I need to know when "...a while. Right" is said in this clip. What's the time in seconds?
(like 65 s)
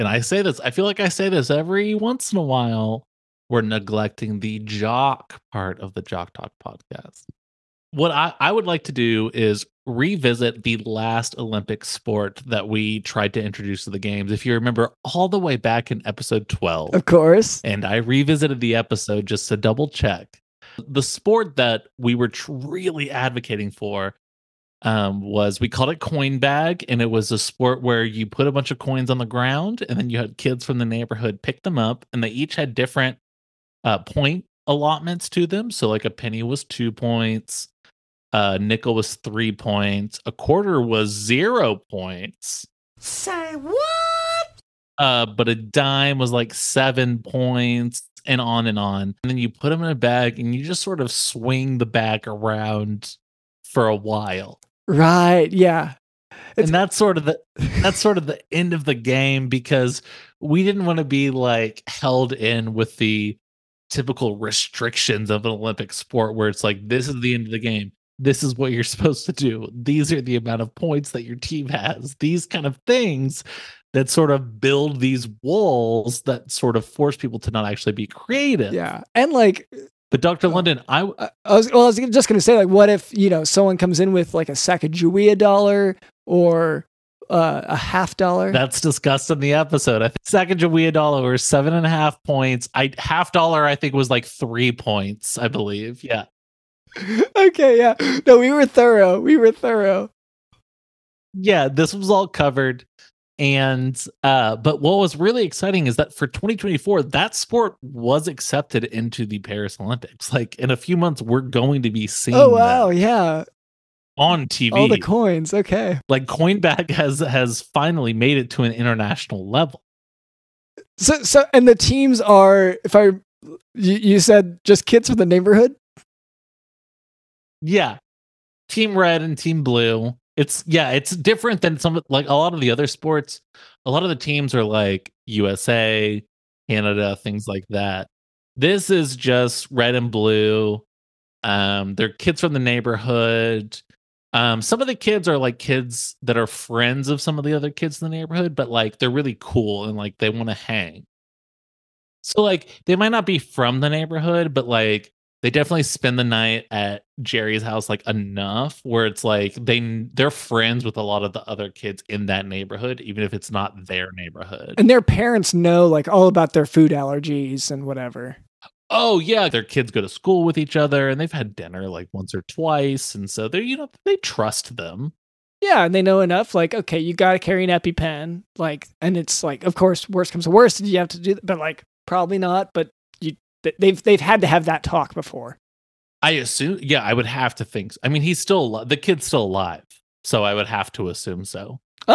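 53 s.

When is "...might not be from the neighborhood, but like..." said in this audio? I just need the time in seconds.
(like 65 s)
152 s.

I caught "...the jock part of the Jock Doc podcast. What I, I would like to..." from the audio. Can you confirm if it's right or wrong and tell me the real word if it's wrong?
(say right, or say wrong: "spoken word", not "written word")
right.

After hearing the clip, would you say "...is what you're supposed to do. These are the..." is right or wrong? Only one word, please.
right.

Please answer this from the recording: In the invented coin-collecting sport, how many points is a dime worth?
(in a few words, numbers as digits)
7.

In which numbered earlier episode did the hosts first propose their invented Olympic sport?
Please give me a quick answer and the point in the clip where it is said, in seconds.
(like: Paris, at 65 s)
12, at 16 s.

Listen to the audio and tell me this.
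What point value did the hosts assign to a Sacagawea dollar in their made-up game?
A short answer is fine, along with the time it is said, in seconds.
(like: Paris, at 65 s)
7.5, at 91 s.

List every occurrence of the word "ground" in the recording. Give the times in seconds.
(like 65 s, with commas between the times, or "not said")
29 s.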